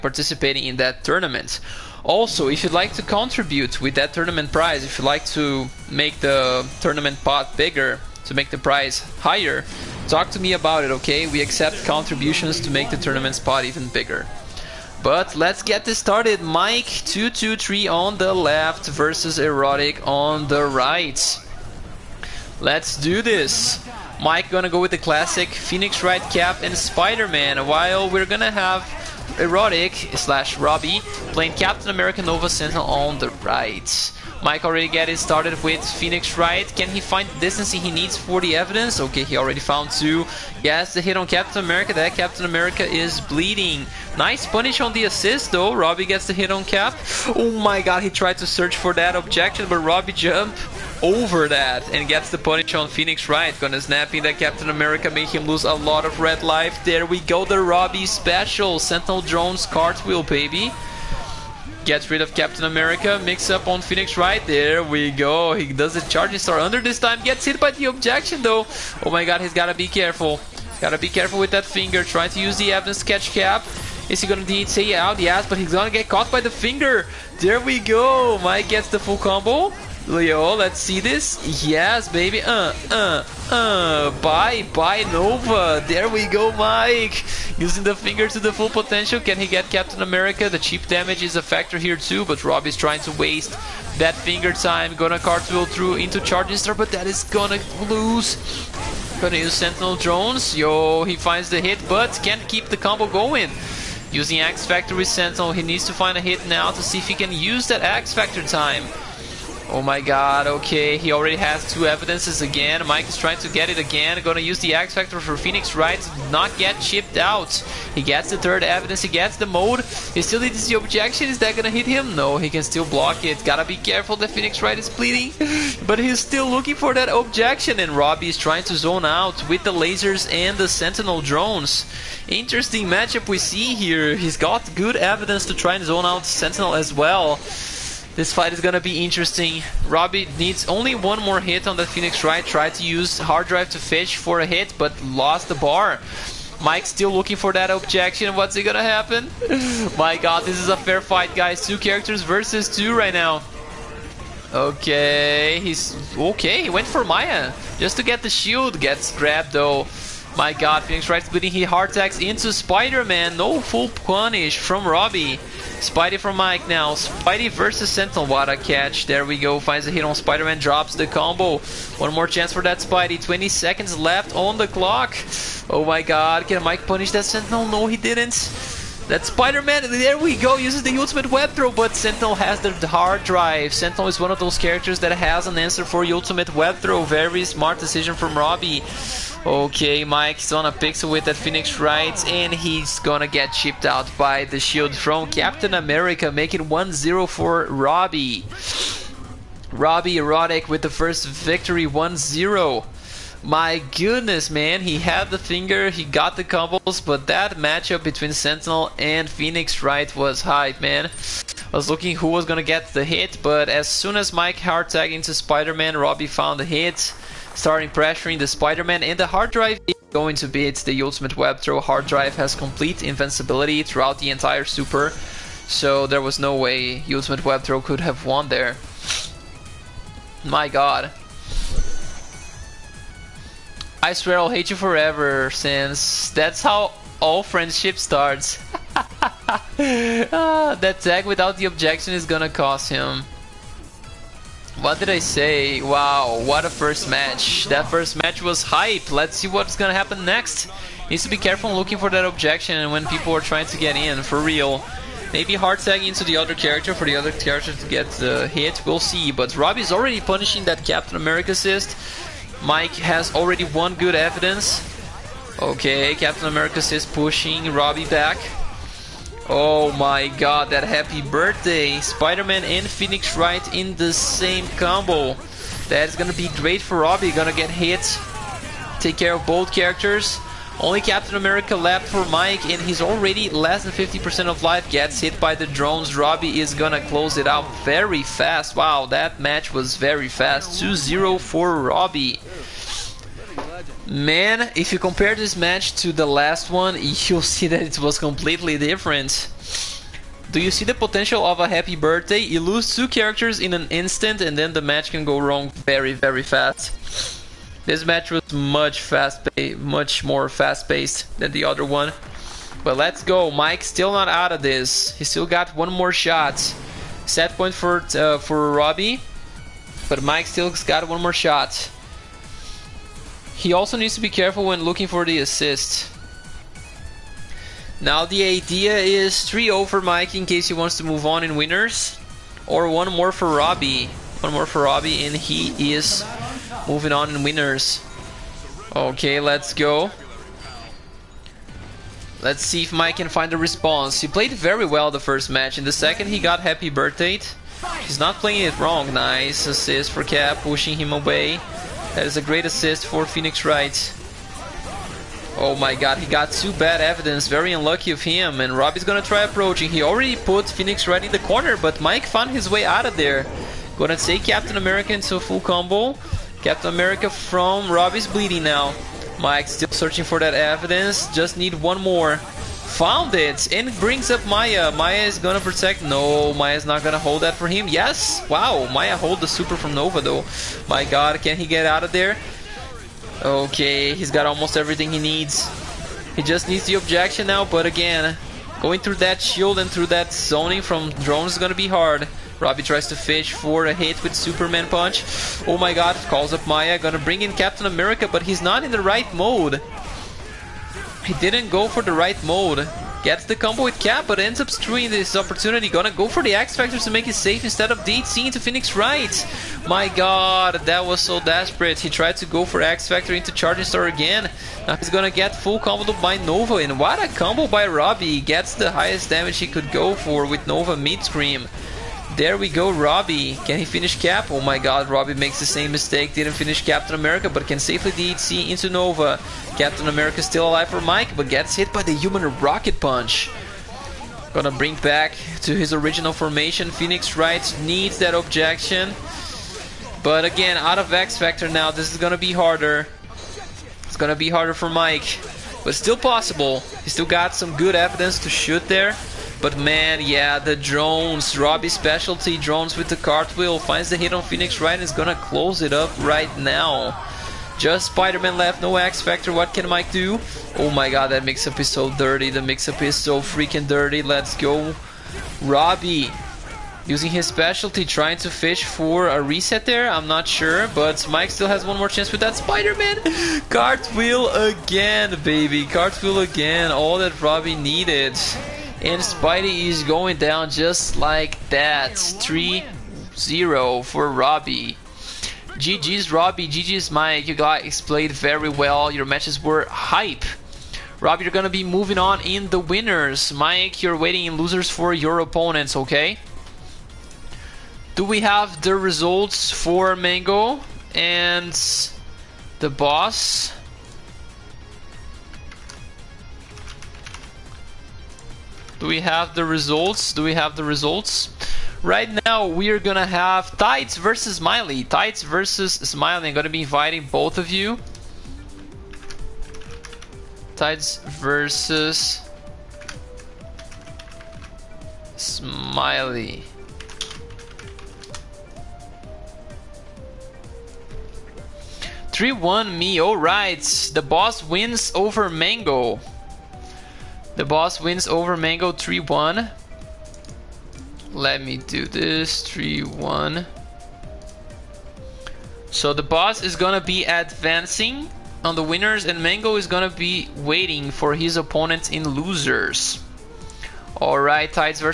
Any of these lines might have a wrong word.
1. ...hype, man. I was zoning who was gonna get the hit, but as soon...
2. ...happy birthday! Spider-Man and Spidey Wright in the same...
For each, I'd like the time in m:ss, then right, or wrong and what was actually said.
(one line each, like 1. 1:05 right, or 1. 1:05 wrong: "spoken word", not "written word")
1. 3:30 wrong: "looking", not "zoning"
2. 4:30 wrong: "Phoenix", not "Spidey".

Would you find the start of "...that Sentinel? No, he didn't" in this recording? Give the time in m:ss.
2:57.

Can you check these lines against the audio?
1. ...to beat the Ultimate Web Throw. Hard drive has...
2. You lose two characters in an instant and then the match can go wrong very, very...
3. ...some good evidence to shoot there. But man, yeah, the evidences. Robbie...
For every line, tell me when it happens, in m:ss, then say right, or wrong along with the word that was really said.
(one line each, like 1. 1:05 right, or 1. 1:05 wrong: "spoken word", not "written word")
1. 3:40 right
2. 5:02 right
3. 7:27 wrong: "drones", not "evidences".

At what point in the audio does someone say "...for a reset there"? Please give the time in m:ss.
7:48.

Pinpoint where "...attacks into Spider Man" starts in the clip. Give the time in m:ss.
2:41.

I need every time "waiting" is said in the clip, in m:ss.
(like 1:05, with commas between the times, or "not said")
8:14, 9:10.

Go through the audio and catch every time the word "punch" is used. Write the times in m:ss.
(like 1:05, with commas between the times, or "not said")
6:34, 7:12.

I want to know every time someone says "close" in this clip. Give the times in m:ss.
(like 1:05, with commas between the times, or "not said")
4:47, 7:35.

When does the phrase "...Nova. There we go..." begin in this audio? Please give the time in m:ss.
1:25.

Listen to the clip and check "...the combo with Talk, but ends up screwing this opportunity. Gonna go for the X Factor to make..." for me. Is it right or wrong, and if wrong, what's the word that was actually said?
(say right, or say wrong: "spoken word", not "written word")
wrong: "Cap", not "Talk".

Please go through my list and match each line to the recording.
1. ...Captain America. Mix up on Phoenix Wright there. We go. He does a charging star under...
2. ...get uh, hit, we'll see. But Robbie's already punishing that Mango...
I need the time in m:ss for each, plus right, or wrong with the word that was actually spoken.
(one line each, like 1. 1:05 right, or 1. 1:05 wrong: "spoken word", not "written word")
1. 1:02 right
2. 4:17 wrong: "Captain", not "Mango".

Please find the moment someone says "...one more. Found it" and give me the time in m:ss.
6:11.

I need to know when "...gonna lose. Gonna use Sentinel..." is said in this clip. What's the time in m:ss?
1:37.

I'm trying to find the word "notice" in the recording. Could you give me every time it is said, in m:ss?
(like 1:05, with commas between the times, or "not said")
not said.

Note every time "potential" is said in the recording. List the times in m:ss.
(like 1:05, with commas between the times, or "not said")
1:28, 5:00.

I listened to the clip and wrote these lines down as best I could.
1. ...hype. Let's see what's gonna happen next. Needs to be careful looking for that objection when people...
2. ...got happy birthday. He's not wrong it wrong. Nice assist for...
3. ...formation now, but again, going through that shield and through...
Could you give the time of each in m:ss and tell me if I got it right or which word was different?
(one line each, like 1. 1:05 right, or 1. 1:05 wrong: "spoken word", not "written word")
1. 4:08 right
2. 5:46 wrong: "playing", not "wrong"
3. 6:26 wrong: "objection", not "formation".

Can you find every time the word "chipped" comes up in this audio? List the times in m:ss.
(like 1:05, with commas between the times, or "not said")
1:56, 3:13.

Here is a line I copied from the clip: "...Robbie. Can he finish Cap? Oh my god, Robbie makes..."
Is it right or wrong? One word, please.
right.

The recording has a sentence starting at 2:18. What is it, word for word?
This fight is gonna be interesting.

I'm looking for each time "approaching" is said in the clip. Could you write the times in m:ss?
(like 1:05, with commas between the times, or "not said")
5:59.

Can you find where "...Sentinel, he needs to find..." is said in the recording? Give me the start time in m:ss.
1:45.